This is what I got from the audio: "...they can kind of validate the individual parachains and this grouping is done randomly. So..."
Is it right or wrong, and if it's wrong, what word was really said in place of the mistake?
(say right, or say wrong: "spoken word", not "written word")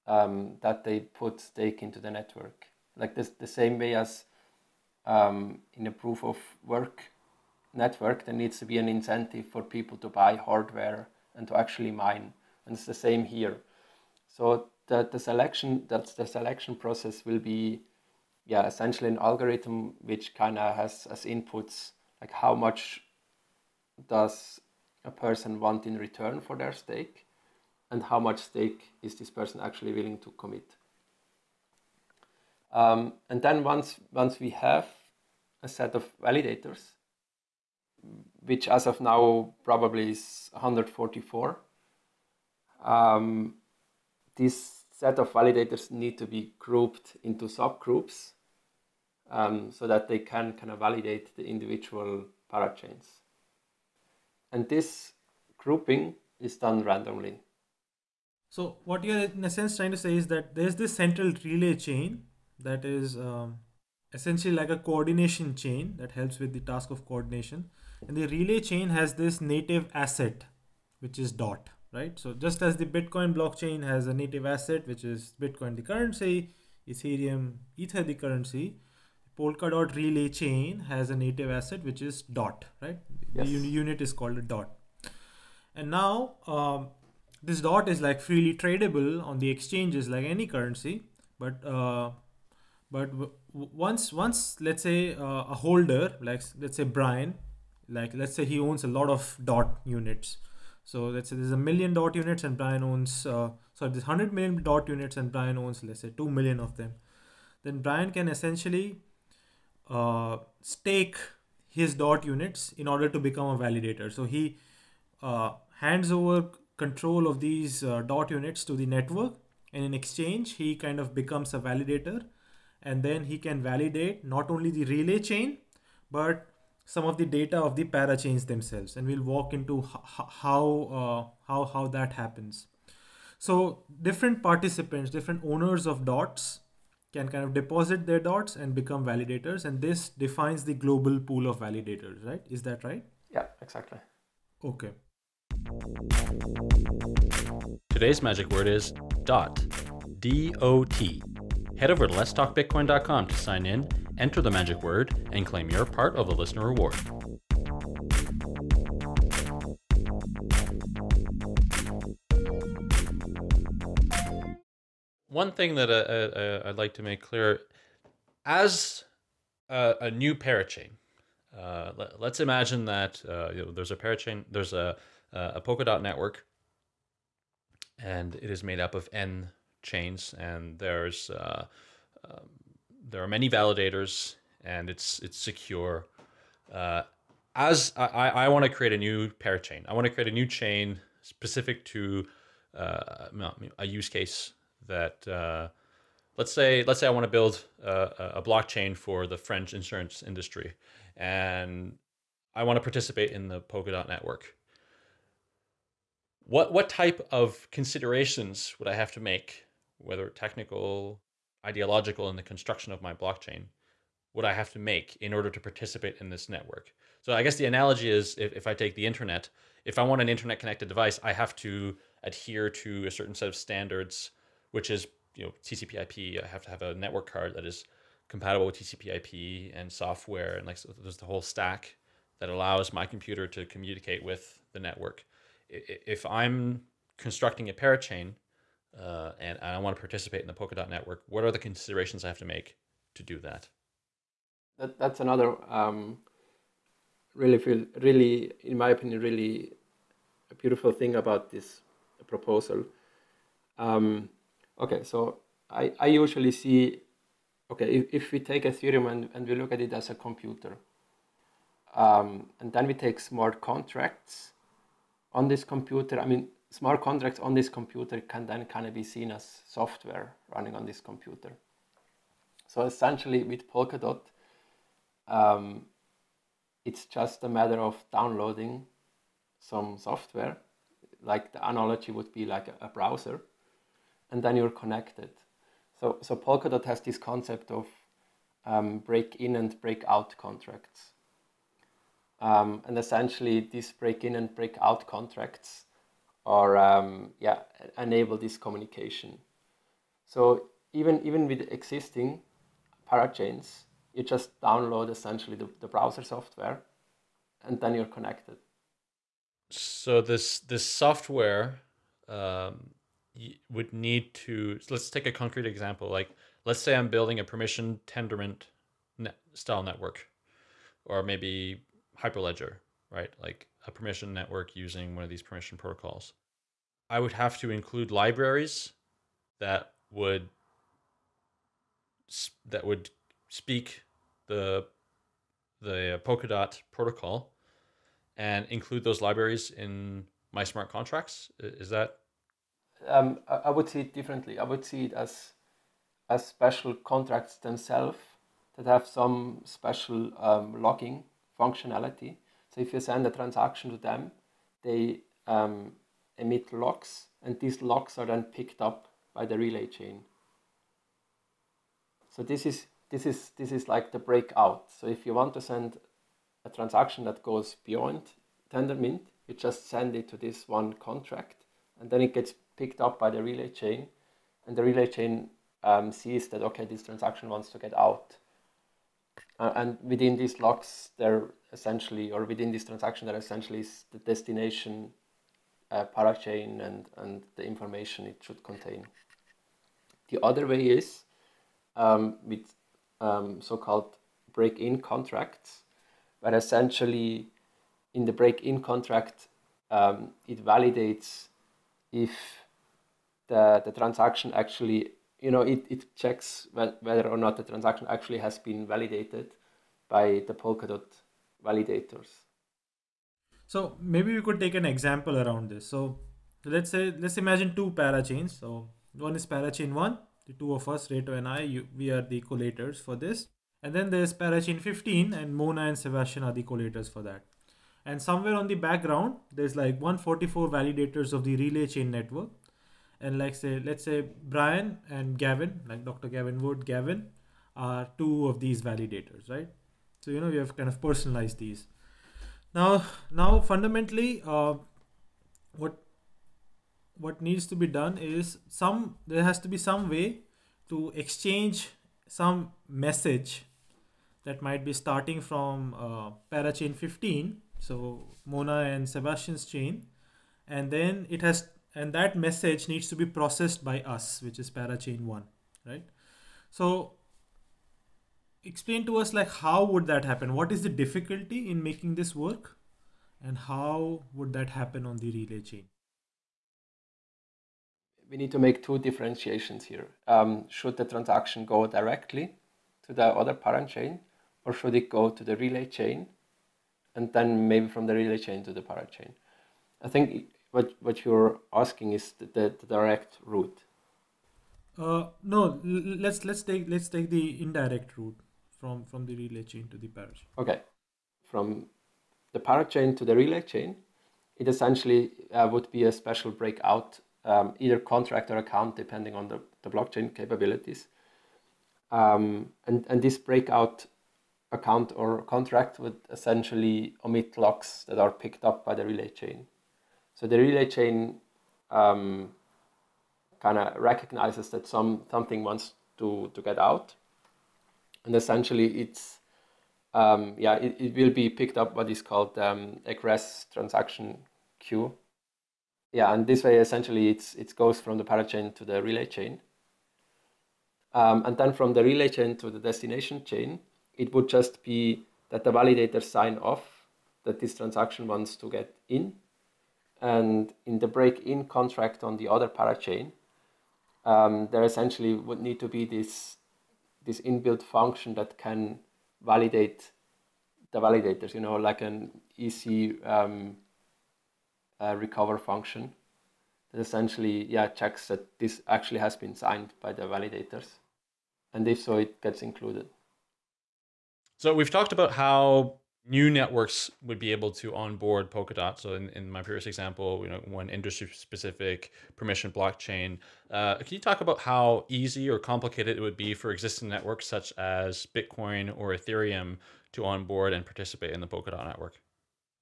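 right.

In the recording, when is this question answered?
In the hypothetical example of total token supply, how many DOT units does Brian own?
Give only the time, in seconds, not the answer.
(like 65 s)
106 s.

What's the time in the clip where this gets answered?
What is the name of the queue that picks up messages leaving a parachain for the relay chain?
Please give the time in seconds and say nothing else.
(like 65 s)
533 s.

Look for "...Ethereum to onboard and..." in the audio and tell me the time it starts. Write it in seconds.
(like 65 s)
589 s.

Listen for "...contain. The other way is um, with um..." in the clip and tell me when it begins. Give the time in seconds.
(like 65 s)
388 s.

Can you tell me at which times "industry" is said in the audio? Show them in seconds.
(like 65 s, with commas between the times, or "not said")
200 s, 580 s.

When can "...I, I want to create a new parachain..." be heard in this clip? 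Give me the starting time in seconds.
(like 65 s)
187 s.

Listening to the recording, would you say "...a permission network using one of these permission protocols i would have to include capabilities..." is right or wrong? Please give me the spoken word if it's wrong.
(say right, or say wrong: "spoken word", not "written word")
wrong: "libraries", not "capabilities".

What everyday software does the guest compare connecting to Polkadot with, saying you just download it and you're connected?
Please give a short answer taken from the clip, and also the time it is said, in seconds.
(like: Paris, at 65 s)
A browser, at 282 s.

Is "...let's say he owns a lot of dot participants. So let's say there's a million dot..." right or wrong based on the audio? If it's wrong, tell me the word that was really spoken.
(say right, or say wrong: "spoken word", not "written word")
wrong: "units", not "participants".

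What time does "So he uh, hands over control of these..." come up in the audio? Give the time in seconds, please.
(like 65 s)
114 s.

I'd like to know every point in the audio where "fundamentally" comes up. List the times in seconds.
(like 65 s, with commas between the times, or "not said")
443 s.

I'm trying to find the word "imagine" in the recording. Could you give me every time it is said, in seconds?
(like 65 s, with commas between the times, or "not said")
172 s, 417 s.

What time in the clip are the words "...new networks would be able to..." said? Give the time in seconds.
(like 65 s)
576 s.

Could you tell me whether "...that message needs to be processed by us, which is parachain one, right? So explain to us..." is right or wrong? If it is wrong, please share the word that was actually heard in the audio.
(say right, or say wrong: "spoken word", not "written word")
right.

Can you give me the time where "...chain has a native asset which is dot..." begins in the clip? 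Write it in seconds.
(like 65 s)
80 s.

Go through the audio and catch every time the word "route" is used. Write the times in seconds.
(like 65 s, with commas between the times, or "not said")
493 s, 498 s.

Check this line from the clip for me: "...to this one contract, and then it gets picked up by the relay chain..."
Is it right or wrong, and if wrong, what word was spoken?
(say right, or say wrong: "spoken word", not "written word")
right.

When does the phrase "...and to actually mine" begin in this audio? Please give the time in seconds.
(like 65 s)
11 s.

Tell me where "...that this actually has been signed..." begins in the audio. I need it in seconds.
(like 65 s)
568 s.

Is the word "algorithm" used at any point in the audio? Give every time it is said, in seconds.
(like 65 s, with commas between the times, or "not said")
19 s.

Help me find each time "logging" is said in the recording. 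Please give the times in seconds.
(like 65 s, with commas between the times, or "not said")
350 s.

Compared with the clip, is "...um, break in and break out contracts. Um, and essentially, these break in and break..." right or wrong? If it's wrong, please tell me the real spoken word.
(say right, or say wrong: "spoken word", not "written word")
right.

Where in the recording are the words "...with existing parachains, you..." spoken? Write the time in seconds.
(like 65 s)
301 s.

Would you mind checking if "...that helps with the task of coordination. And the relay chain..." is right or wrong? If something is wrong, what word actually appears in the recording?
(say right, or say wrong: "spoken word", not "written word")
right.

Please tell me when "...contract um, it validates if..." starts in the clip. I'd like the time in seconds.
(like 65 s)
398 s.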